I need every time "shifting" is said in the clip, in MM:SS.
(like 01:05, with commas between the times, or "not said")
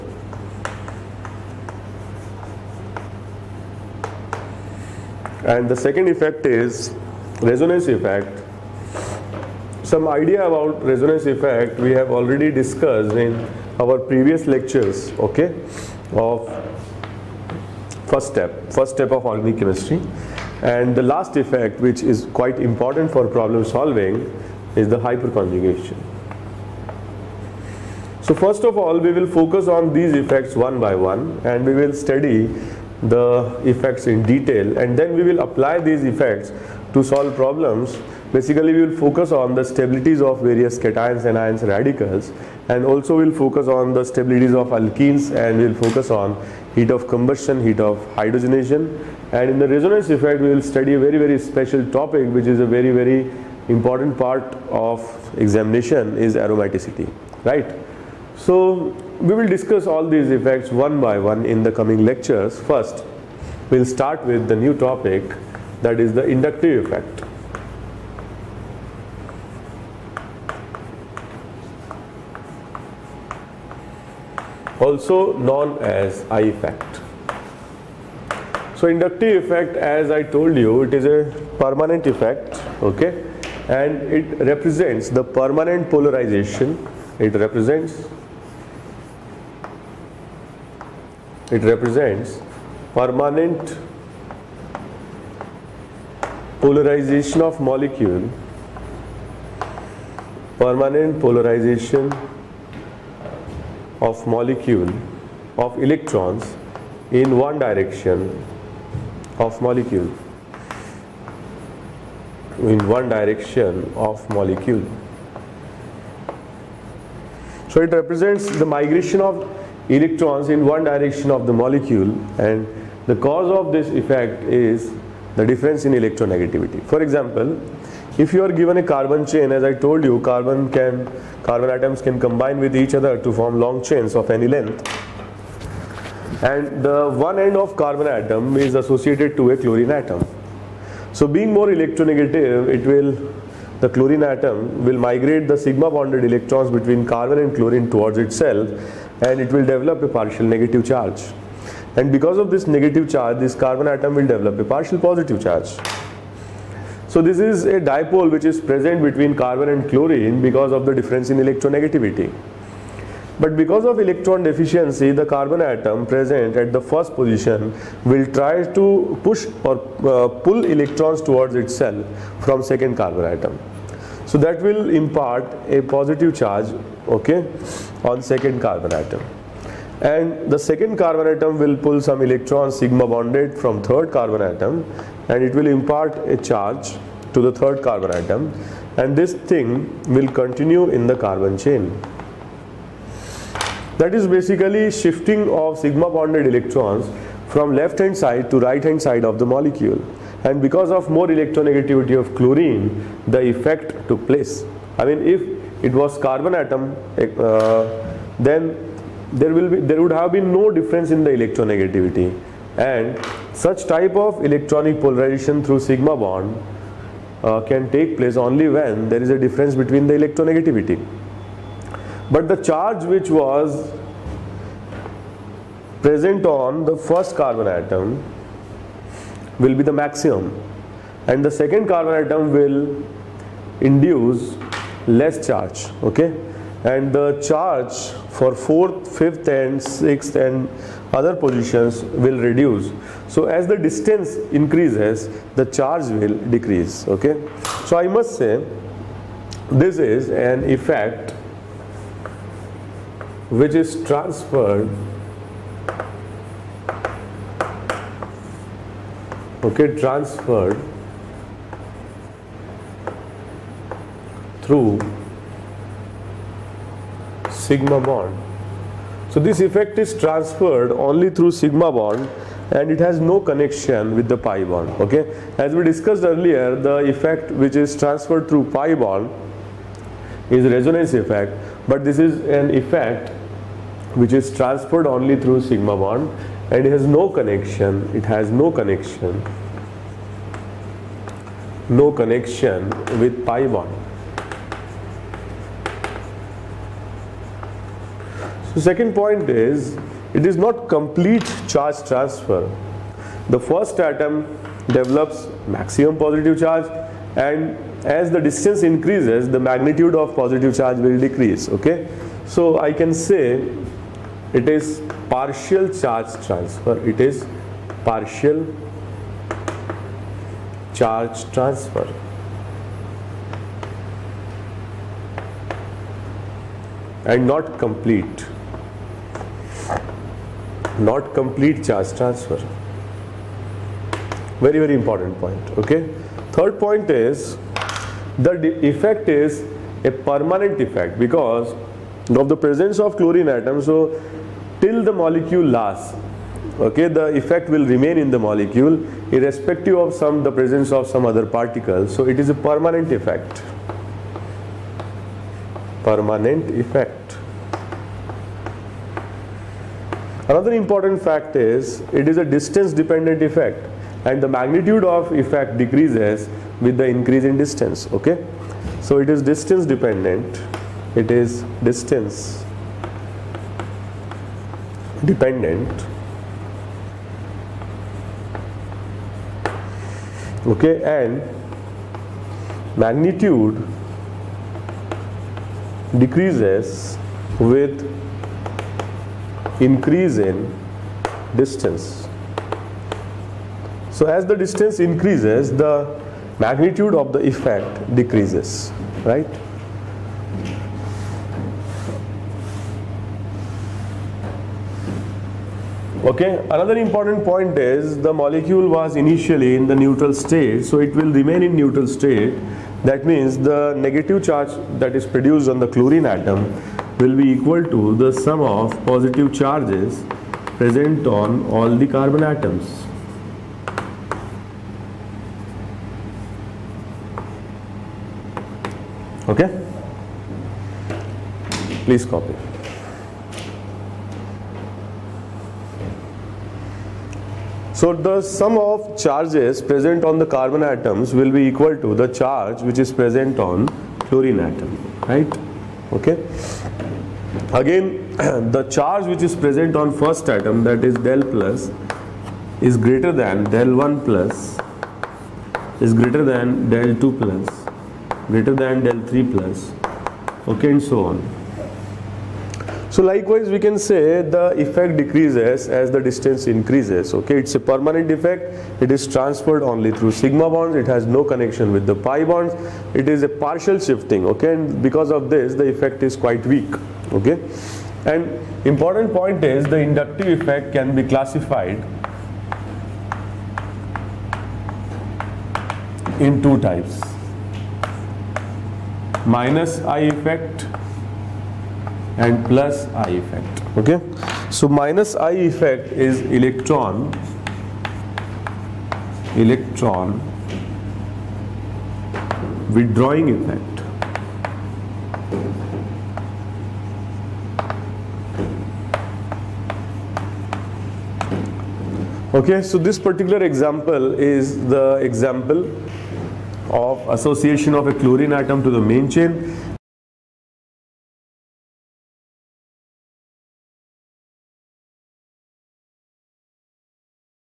03:14, 07:53.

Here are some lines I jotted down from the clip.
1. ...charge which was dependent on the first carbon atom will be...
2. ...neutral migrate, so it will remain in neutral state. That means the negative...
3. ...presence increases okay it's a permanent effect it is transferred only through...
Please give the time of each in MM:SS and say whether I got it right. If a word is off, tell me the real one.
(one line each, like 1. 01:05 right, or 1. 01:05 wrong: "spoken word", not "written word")
1. 03:42 wrong: "present", not "dependent"
2. 06:49 wrong: "state", not "migrate"
3. 07:46 wrong: "distance", not "presence".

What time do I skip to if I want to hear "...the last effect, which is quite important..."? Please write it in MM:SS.
00:20.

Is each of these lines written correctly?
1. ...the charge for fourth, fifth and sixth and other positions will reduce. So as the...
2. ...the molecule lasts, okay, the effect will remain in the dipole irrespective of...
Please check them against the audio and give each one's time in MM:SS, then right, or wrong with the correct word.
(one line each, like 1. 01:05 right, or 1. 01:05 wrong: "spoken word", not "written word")
1. 03:57 right
2. 05:45 wrong: "molecule", not "dipole".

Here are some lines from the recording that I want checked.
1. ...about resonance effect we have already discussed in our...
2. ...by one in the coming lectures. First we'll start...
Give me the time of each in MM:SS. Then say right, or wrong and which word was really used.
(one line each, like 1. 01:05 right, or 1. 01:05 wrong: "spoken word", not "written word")
1. 00:10 right
2. 01:01 right.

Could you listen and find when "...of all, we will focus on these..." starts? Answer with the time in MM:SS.
00:28.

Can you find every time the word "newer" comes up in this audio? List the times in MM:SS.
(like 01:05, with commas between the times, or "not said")
not said.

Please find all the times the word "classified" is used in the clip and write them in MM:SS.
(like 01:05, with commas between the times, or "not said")
08:01.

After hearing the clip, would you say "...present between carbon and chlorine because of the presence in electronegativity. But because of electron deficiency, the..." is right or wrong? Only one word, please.
wrong.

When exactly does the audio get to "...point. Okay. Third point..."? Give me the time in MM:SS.
05:35.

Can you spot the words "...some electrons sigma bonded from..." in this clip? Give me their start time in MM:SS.
03:02.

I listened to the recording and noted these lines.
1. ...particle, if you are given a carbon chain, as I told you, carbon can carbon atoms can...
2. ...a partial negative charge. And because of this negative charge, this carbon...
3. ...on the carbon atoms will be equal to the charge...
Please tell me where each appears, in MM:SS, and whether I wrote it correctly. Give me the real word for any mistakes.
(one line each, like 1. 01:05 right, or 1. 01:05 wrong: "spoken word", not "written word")
1. 02:07 wrong: "example", not "particle"
2. 02:30 right
3. 07:20 right.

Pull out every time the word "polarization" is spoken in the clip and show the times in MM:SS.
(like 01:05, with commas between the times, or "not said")
01:25, 01:36, 01:41, 03:35.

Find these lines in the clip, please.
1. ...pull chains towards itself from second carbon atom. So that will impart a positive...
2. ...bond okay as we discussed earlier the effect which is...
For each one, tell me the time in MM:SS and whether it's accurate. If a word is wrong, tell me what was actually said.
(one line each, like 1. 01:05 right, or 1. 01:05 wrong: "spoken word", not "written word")
1. 02:50 wrong: "electrons", not "chains"
2. 04:34 right.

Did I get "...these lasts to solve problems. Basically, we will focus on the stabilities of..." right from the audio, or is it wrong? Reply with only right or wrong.
wrong.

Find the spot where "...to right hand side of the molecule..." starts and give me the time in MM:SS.
03:18.